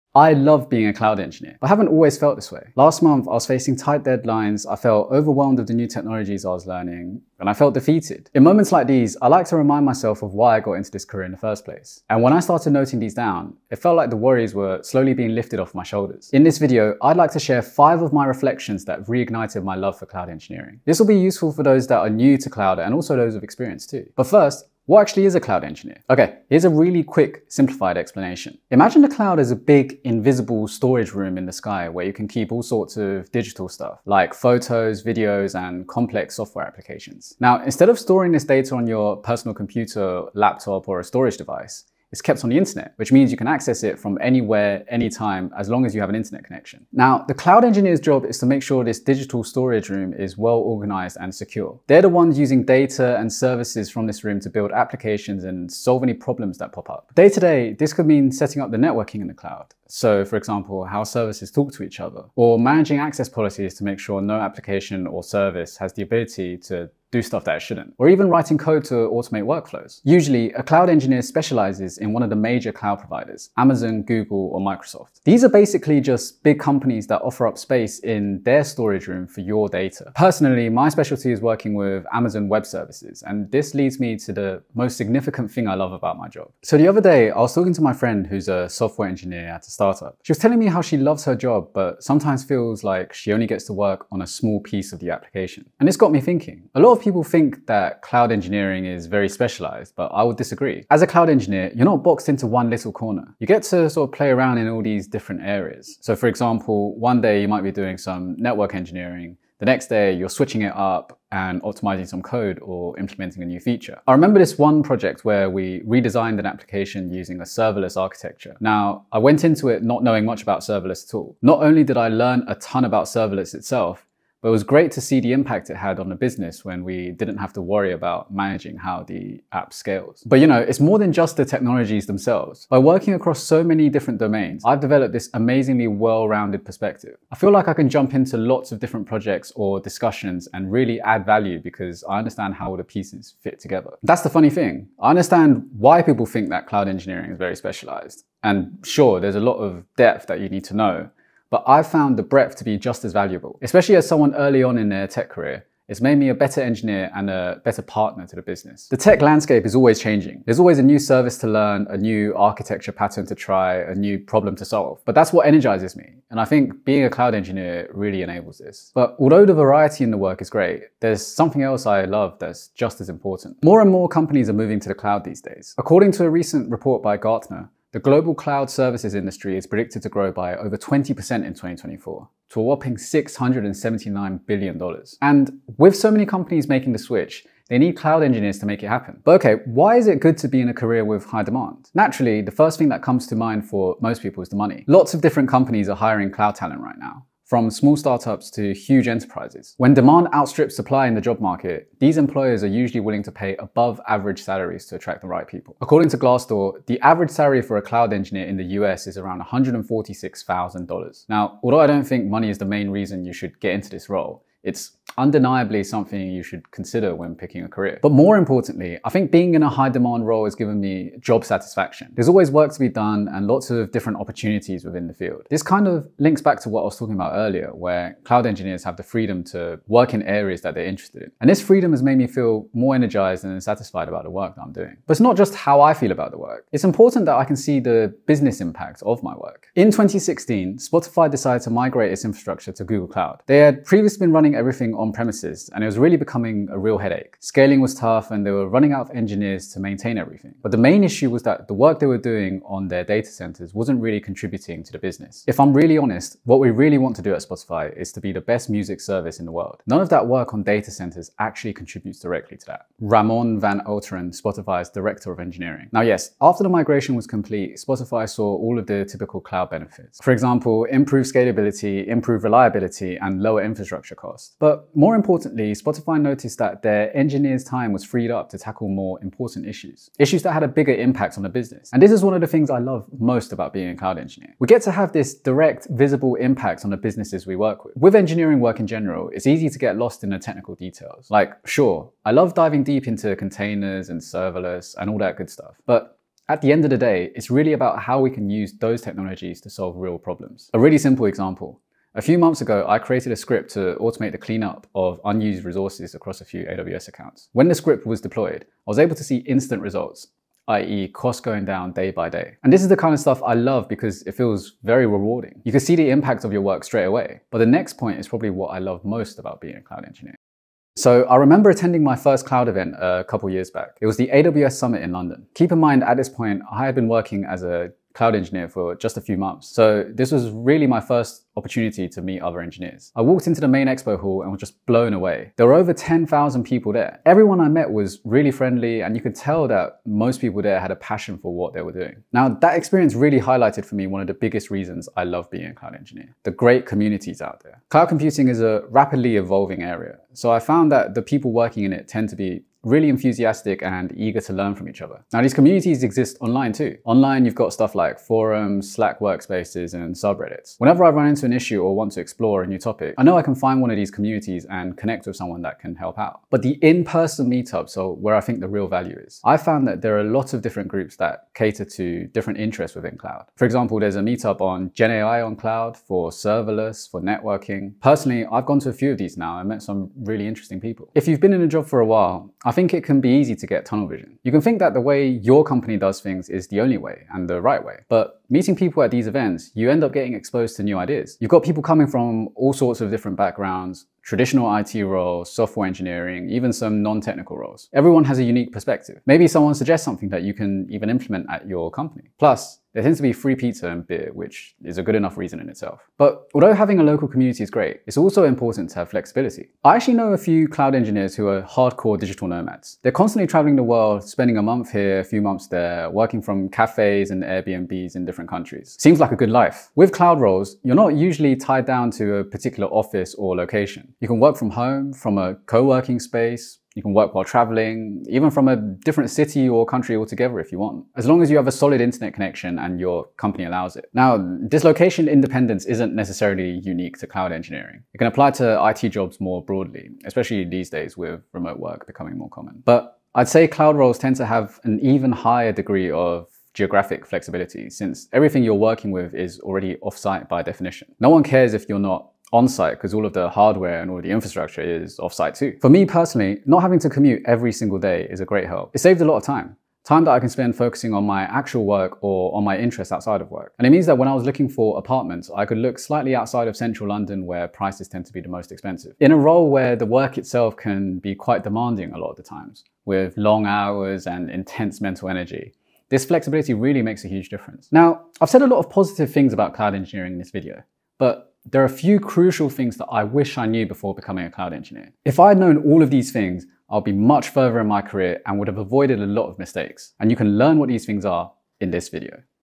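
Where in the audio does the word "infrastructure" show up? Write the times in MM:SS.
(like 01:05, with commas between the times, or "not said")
04:02, 04:33, 07:34.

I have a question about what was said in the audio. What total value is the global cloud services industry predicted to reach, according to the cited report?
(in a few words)
$679 billion.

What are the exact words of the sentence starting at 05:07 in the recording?
When the script was deployed, I was able to see instant results, i.e.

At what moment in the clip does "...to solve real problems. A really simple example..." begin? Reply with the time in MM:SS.
04:59.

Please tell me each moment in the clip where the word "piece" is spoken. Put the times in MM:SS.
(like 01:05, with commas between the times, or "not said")
01:34, 02:22.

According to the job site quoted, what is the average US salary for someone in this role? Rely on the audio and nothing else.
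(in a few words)
$146,000.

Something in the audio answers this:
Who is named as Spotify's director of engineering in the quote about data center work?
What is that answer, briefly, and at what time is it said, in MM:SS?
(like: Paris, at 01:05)
Ramon Van Alteren, at 04:22.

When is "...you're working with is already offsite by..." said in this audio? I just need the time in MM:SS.
07:28.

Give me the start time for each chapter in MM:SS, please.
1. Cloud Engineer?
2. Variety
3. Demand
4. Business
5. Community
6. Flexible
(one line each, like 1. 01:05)
1. 00:25
2. 01:25
3. 02:53
4. 03:58
5. 05:20
6. 06:49.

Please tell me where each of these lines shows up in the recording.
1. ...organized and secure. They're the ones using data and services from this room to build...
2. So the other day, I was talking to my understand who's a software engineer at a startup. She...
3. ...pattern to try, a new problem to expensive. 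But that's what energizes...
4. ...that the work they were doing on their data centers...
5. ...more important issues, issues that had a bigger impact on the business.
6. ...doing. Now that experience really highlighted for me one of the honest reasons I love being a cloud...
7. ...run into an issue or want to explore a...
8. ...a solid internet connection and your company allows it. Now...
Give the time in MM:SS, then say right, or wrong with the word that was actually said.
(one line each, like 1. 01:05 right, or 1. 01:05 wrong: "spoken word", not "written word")
1. 00:50 right
2. 01:26 wrong: "friend", not "understand"
3. 02:42 wrong: "solve", not "expensive"
4. 04:11 right
5. 04:38 right
6. 05:41 wrong: "biggest", not "honest"
7. 06:01 right
8. 07:11 right.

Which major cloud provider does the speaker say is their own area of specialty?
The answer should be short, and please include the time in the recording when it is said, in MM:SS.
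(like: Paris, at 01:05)
Amazon Web Services, at 01:22.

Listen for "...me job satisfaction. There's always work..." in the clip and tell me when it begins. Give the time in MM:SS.
03:40.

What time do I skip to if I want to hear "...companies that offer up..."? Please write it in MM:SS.
01:16.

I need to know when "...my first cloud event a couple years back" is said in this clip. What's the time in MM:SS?
05:22.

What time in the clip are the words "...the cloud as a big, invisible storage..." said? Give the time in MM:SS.
00:29.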